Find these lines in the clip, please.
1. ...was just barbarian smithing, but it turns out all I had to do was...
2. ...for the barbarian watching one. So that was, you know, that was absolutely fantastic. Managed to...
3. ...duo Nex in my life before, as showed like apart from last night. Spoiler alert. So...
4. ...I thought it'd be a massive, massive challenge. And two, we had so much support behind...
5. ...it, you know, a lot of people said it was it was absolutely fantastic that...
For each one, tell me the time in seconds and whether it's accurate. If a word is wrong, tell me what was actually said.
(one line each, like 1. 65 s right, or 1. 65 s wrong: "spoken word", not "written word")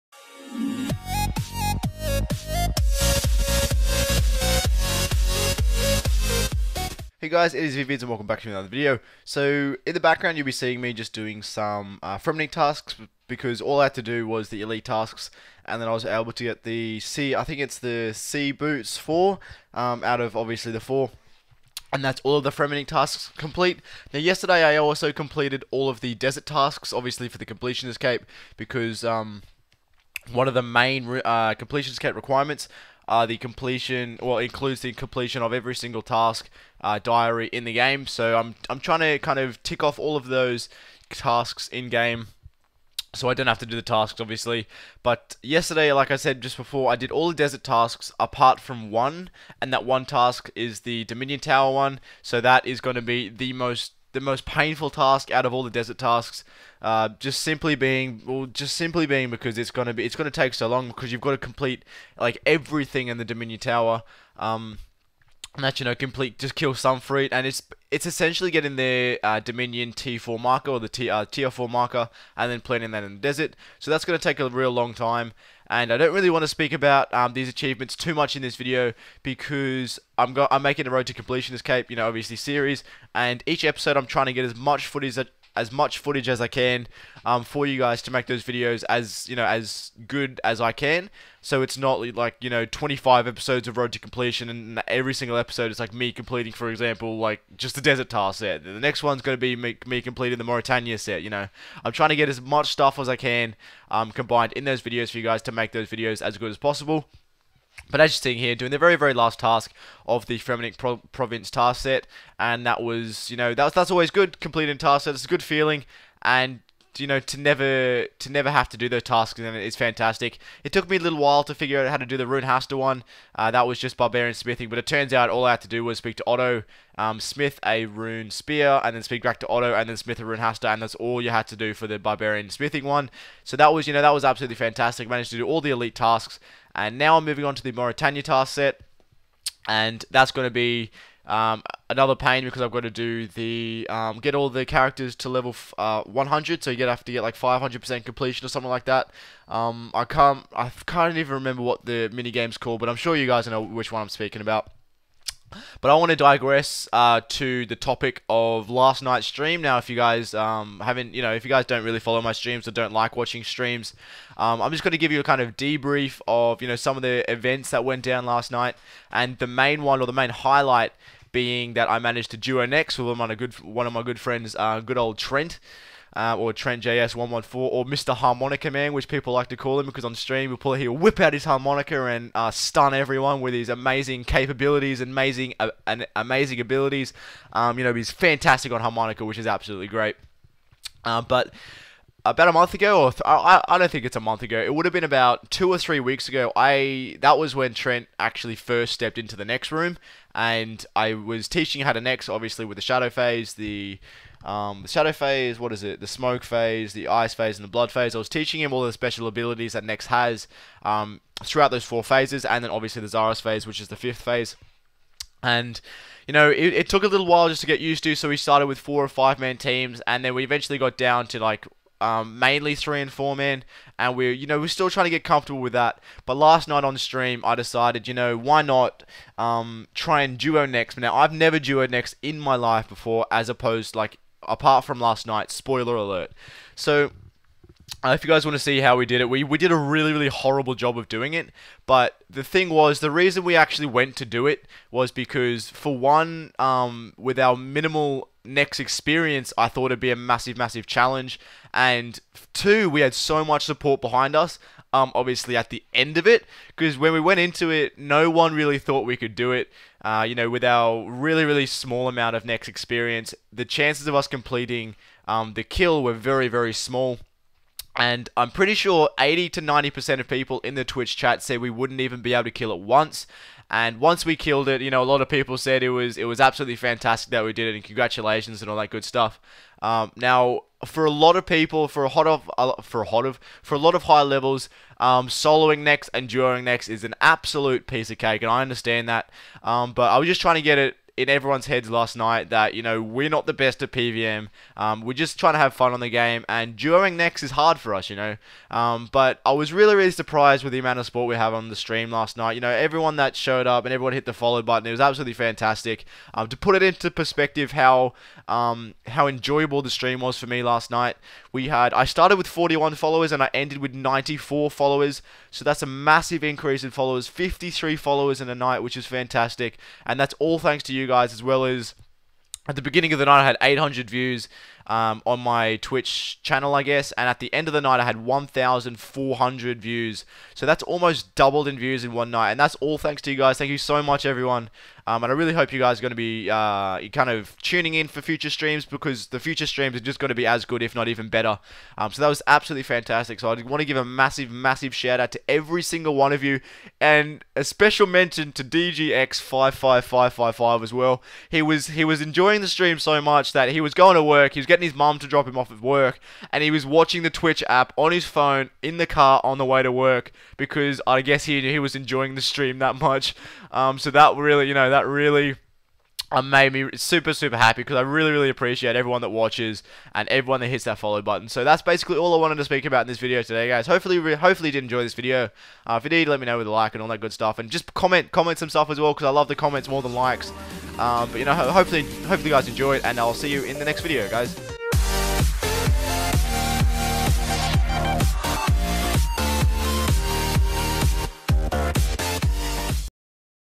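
1. 123 s right
2. 131 s wrong: "smithing", not "watching"
3. 231 s wrong: "opposed", not "showed"
4. 249 s right
5. 274 s right.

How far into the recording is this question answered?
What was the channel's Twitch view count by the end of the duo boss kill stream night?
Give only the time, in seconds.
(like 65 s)
328 s.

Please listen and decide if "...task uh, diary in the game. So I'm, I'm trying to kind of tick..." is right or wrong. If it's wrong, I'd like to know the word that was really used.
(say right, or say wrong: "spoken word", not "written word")
right.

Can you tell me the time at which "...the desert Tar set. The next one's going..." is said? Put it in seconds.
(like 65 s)
97 s.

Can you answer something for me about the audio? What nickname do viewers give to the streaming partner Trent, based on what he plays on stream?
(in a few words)
Mr. Harmonica Man.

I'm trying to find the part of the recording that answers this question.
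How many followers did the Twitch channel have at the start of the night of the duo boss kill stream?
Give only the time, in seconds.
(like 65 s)
312 s.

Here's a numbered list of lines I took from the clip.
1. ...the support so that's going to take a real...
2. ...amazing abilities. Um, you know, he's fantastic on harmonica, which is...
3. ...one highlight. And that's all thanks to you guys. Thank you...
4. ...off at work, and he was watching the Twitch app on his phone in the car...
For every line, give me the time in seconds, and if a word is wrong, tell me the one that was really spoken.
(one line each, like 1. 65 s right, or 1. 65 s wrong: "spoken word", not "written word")
1. 73 s wrong: "desert", not "support"
2. 186 s right
3. 332 s wrong: "night", not "highlight"
4. 355 s right.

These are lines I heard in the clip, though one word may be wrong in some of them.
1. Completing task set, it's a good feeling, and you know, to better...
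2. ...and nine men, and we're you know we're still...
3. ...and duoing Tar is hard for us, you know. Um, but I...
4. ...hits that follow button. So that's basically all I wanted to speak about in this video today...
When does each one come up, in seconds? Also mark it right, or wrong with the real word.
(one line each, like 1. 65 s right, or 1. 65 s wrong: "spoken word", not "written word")
1. 114 s wrong: "never", not "better"
2. 223 s wrong: "four", not "nine"
3. 296 s wrong: "Nex", not "Tar"
4. 370 s right.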